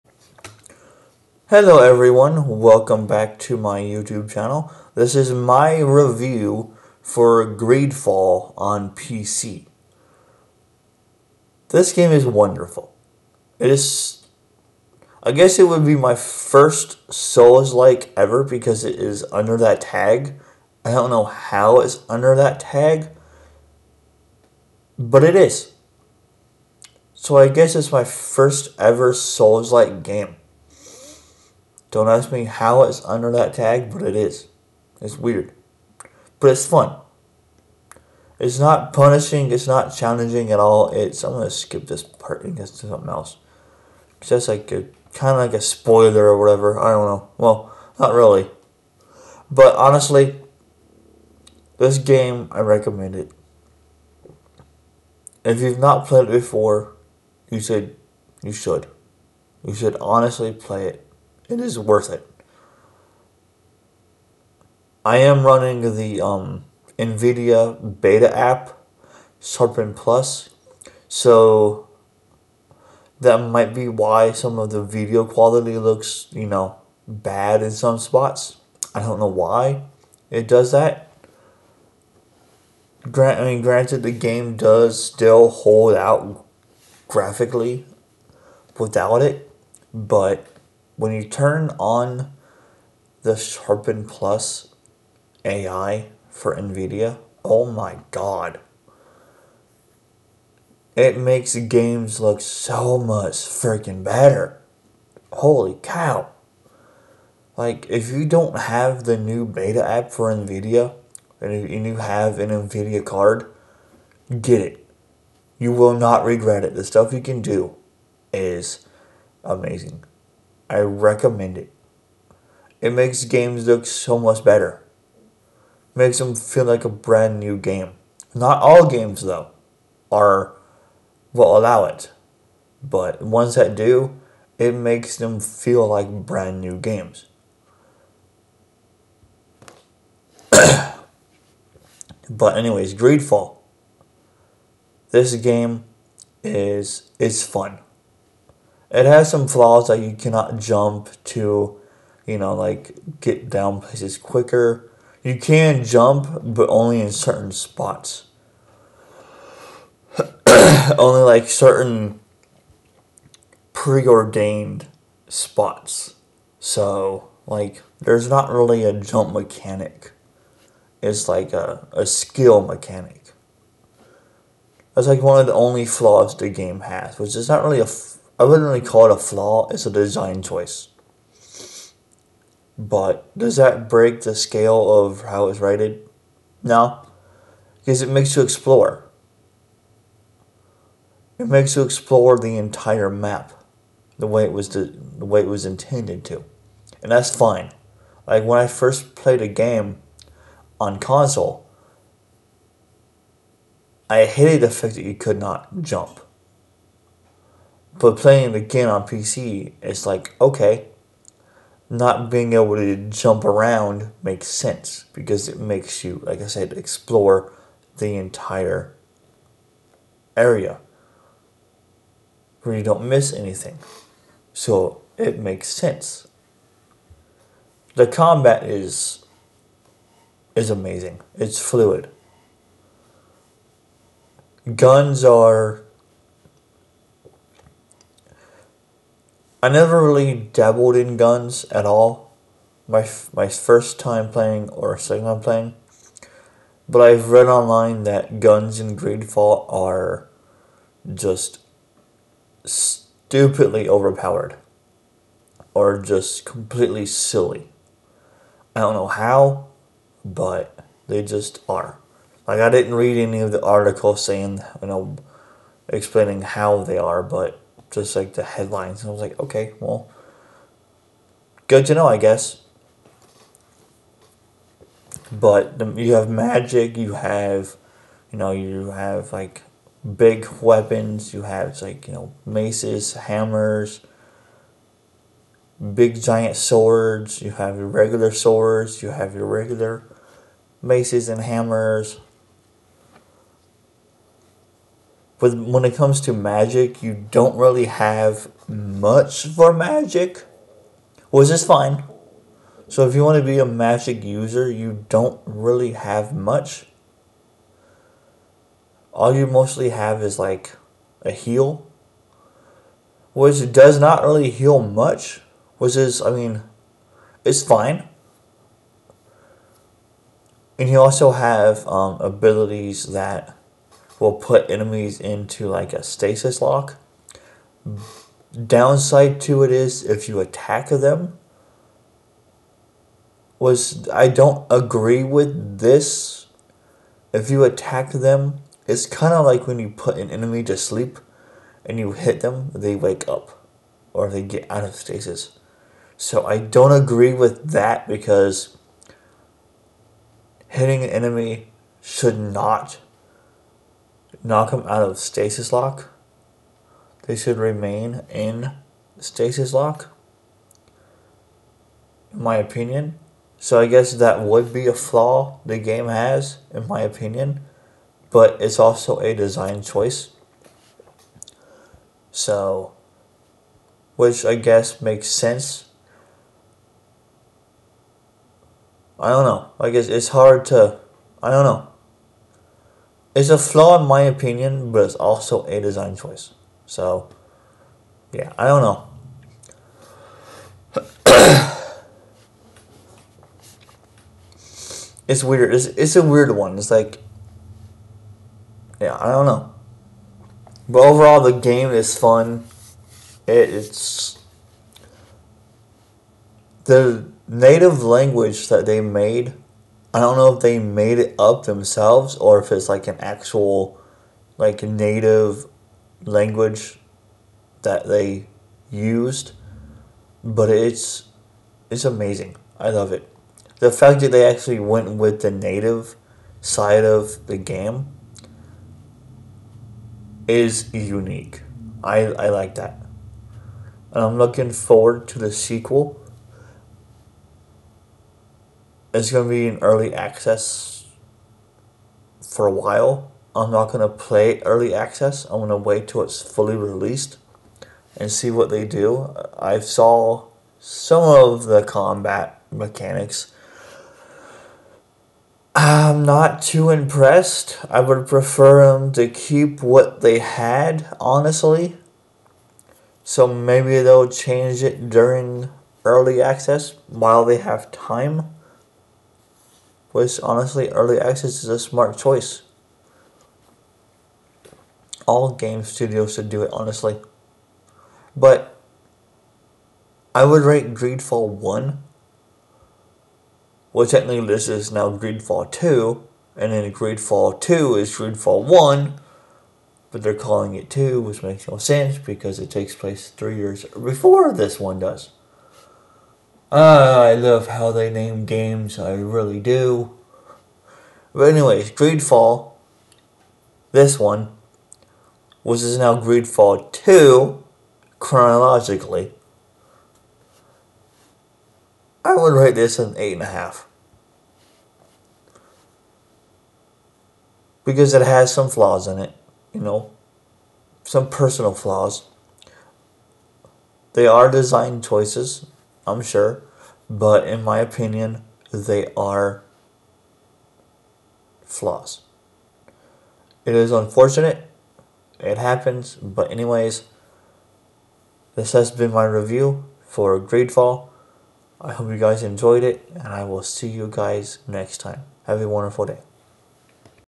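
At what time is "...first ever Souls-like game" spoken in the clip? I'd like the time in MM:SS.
00:28.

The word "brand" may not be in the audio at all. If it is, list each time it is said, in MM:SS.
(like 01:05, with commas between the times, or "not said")
02:06, 02:16.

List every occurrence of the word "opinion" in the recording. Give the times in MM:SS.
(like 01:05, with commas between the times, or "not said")
06:02, 06:07, 06:24, 08:47.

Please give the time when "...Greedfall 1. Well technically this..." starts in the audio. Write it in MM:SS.
08:00.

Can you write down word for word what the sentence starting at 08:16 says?
Ah, I love how they name games, I really do.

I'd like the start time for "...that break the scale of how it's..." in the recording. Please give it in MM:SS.
03:03.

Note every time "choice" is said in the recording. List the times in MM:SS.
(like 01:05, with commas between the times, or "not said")
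03:00, 06:09, 06:26, 07:52, 08:45.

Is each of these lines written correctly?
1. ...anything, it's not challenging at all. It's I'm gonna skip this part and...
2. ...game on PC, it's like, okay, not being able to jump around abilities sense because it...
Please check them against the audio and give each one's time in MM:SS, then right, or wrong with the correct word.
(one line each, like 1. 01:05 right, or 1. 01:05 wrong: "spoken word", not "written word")
1. 00:38 wrong: "punishing", not "anything"
2. 03:28 wrong: "makes", not "abilities".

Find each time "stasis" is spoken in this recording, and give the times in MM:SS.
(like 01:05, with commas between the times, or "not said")
05:26, 05:44, 05:55, 05:59.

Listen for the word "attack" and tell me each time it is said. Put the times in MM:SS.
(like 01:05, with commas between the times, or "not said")
05:30, 05:37.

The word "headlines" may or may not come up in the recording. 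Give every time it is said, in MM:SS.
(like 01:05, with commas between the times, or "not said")
04:28.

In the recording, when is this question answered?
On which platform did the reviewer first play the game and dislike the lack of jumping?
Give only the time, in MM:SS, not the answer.
03:20.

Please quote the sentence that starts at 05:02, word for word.
So if you want to be a magic user, you don't really have much.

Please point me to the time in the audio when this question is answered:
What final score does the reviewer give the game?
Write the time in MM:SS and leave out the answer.
08:33.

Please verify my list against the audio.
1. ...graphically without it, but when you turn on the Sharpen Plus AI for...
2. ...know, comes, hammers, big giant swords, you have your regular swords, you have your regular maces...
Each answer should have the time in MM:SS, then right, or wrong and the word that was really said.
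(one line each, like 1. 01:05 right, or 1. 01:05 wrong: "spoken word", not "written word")
1. 01:27 right
2. 04:42 wrong: "maces", not "comes".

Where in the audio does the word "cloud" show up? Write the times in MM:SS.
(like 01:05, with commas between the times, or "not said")
not said.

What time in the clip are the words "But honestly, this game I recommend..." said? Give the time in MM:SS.
00:49.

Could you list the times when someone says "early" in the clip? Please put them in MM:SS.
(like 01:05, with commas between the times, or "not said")
07:19, 07:24, 07:46, 07:50.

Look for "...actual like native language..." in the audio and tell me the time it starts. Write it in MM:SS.
06:53.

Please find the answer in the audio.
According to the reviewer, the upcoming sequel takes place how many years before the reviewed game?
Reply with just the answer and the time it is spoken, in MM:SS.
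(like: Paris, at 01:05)
3, at 08:13.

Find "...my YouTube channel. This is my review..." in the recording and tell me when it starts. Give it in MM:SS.
00:03.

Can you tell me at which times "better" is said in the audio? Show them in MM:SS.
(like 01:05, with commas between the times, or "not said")
01:44, 02:04.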